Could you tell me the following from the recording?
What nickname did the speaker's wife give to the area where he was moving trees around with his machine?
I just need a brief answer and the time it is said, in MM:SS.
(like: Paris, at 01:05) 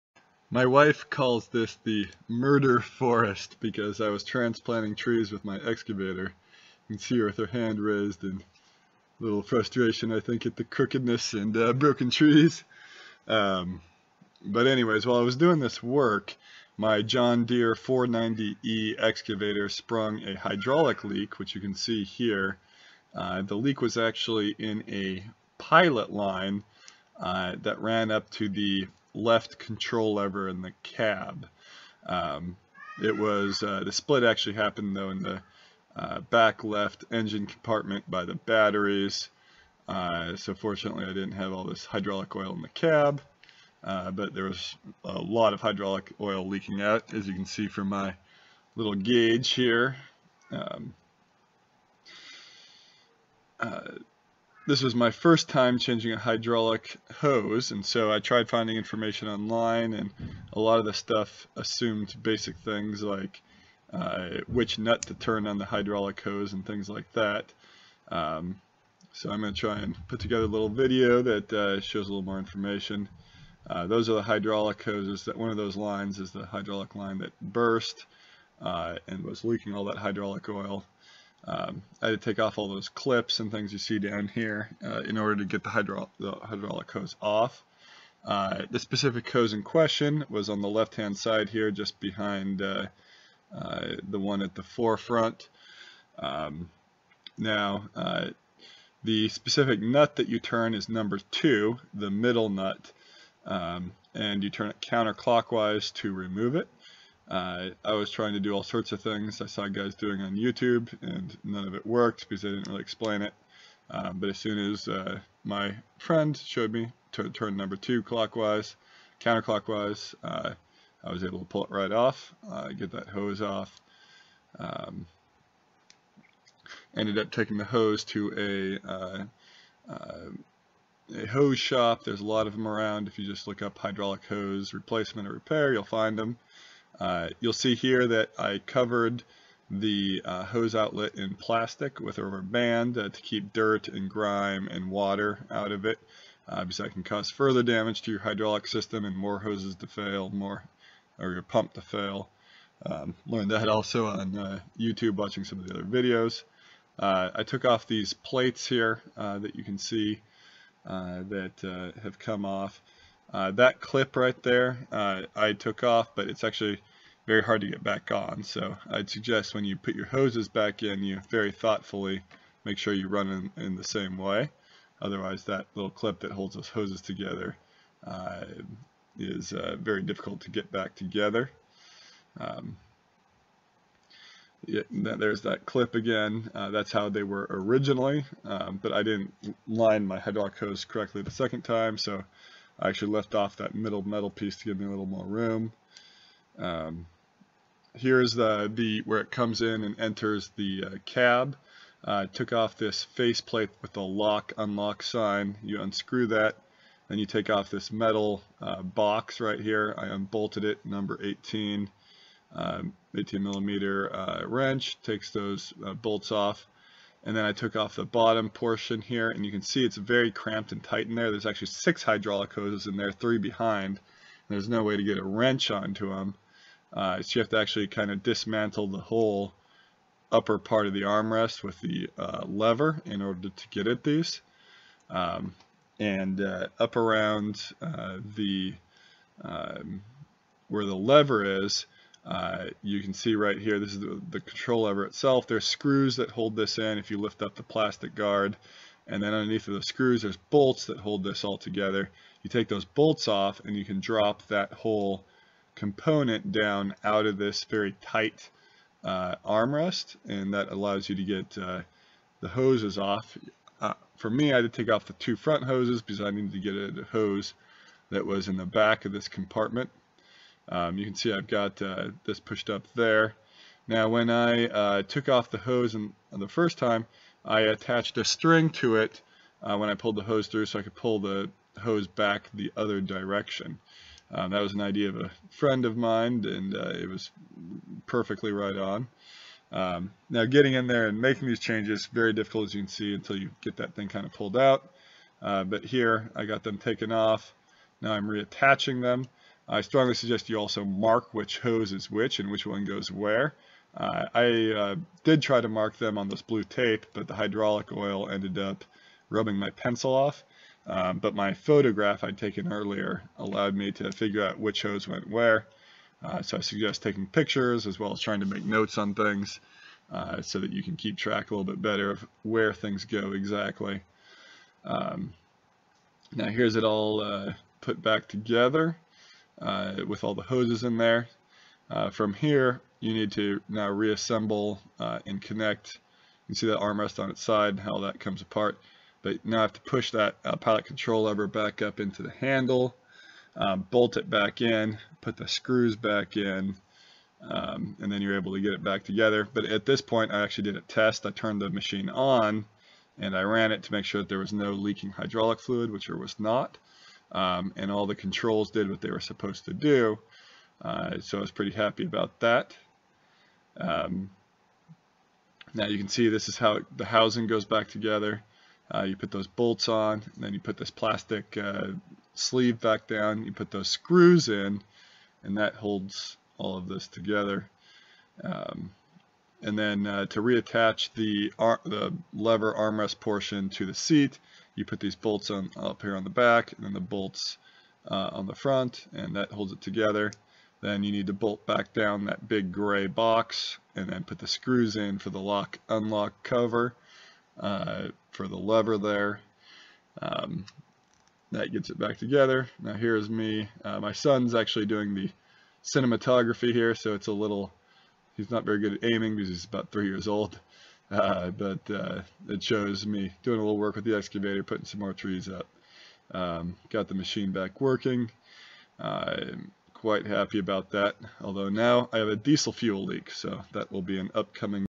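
the murder forest, at 00:01.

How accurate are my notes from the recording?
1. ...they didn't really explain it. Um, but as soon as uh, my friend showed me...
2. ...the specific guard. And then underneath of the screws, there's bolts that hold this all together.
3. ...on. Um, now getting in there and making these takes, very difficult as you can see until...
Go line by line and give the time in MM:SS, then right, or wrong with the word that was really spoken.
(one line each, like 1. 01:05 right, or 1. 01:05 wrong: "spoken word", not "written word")
1. 01:52 right
2. 04:07 wrong: "plastic", not "specific"
3. 04:48 wrong: "changes", not "takes".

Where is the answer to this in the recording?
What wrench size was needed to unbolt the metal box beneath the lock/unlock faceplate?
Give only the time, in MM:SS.
03:33.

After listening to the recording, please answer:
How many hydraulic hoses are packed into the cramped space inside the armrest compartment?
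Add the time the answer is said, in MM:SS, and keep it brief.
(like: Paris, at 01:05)
6, at 03:41.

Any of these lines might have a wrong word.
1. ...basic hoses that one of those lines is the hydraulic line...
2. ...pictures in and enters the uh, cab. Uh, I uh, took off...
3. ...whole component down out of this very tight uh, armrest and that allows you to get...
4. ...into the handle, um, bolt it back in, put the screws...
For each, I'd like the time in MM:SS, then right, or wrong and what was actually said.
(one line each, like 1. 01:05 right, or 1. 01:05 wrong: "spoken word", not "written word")
1. 01:14 wrong: "hydraulic", not "basic"
2. 03:19 wrong: "comes", not "pictures"
3. 04:14 right
4. 05:41 right.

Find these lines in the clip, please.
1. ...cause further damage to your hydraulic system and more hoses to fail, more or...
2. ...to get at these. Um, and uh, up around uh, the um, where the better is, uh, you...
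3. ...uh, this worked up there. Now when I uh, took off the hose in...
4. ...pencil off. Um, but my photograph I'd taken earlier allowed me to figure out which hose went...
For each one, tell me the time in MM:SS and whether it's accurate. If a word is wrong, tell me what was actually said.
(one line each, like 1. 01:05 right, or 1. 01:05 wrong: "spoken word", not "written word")
1. 02:27 right
2. 03:53 wrong: "lever", not "better"
3. 04:31 wrong: "pushed", not "worked"
4. 05:09 right.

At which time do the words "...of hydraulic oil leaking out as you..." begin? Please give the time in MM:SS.
00:45.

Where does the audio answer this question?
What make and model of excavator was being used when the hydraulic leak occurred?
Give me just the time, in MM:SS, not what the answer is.
00:17.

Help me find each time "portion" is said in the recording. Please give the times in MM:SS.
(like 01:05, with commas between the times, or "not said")
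03:38, 06:23.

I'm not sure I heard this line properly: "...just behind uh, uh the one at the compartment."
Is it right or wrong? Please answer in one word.
wrong.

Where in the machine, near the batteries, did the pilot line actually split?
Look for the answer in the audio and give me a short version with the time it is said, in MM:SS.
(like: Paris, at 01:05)
back left engine compartment, at 00:36.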